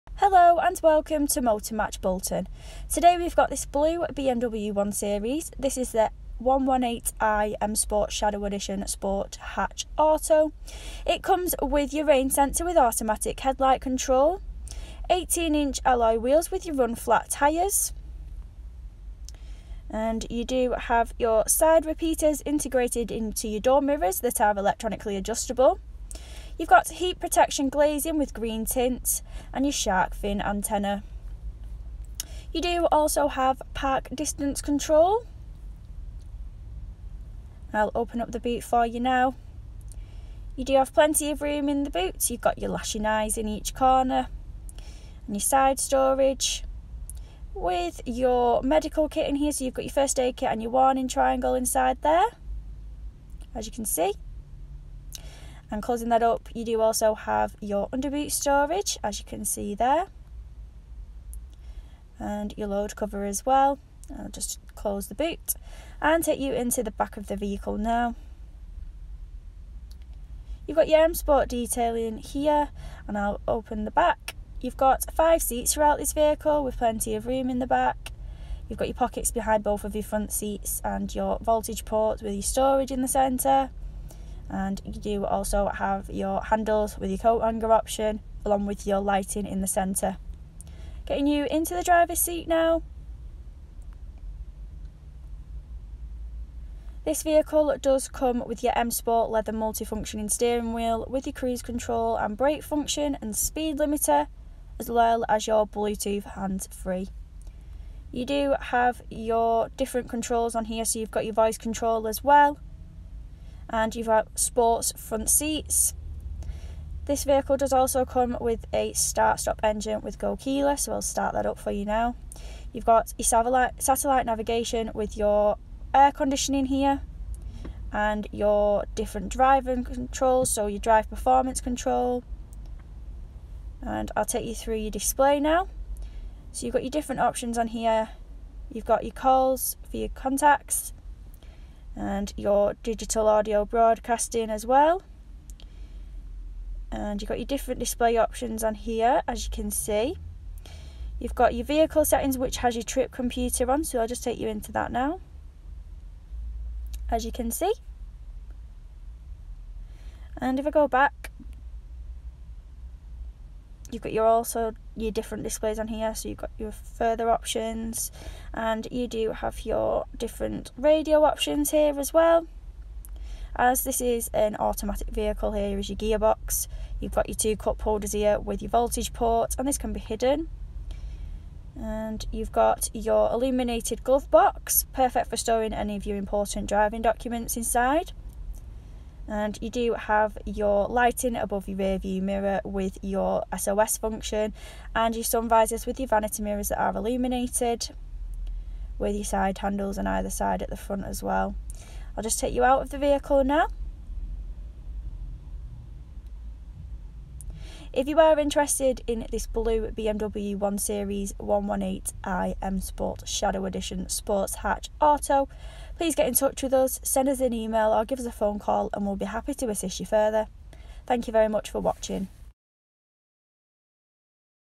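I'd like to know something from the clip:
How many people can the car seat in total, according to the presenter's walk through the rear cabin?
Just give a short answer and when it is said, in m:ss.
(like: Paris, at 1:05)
5, at 1:15.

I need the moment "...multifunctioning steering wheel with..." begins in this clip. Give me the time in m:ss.
1:39.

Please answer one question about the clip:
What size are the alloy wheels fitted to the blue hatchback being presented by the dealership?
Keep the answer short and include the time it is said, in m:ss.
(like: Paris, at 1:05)
18 inch, at 0:15.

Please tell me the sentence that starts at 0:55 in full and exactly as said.
And closing that up, you do also have your underboot storage, as you can see there.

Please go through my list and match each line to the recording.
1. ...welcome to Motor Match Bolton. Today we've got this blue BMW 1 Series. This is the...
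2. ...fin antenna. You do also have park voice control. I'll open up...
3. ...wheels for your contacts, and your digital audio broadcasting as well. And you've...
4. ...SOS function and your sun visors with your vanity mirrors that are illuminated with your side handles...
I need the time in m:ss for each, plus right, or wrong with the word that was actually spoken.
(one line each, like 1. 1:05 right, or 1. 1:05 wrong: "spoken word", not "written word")
1. 0:00 right
2. 0:30 wrong: "distance", not "voice"
3. 2:19 wrong: "calls", not "wheels"
4. 3:13 right.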